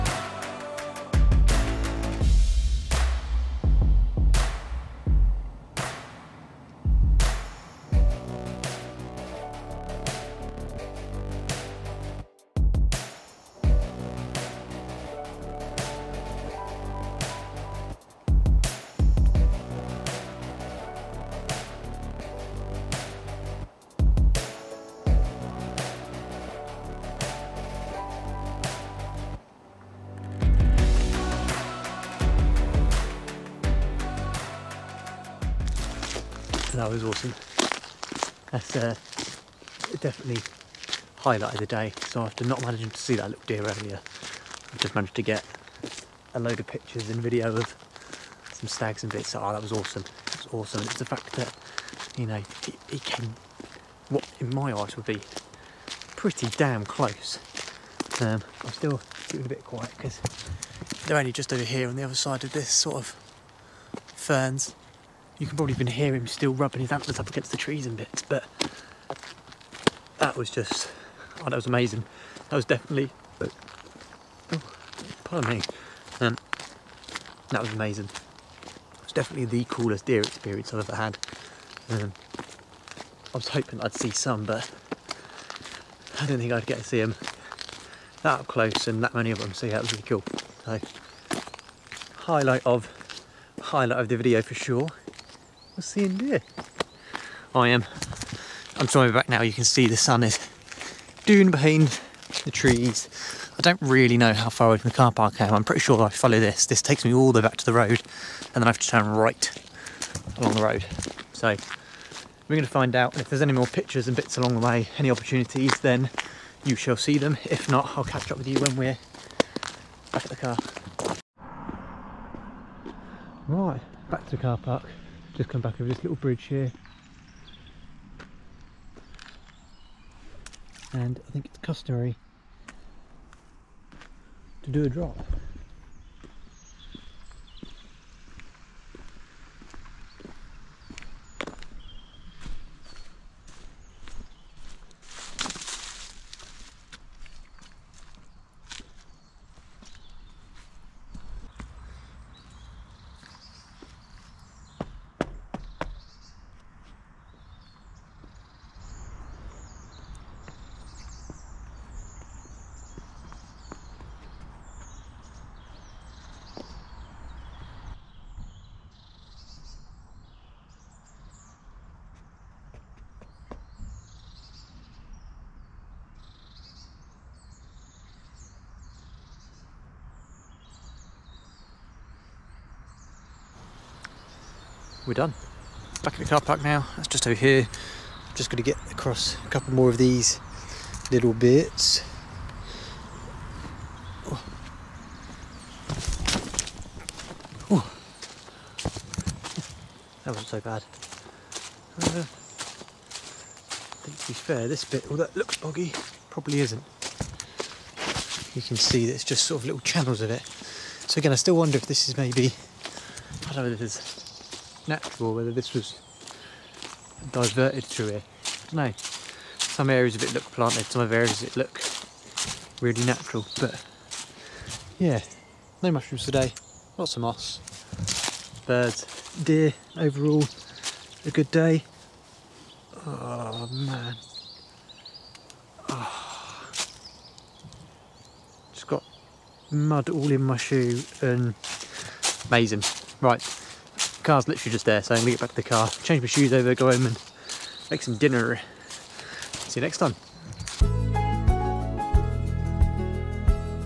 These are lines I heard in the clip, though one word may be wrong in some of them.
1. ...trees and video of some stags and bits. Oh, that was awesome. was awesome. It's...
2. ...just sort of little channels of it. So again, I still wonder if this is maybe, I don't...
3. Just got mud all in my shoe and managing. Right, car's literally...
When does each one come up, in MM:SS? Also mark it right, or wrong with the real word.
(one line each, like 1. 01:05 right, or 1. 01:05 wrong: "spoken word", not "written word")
1. 00:46 wrong: "pictures", not "trees"
2. 03:29 right
3. 03:58 wrong: "amazing", not "managing".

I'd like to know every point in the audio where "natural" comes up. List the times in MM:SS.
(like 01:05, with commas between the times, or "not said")
03:34, 03:43.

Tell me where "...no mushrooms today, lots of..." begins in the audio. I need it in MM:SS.
03:45.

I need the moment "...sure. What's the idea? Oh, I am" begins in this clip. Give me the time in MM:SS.
01:34.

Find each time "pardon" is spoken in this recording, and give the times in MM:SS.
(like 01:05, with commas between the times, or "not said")
01:15.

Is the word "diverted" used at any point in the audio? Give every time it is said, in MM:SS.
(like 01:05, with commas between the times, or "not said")
03:37.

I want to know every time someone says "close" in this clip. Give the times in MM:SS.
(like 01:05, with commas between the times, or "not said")
00:56, 01:28.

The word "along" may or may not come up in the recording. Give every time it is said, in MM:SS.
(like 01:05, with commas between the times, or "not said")
01:50, 01:54.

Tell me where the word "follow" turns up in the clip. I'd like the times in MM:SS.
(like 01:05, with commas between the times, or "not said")
01:46.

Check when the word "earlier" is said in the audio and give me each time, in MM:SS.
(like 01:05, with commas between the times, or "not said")
00:43.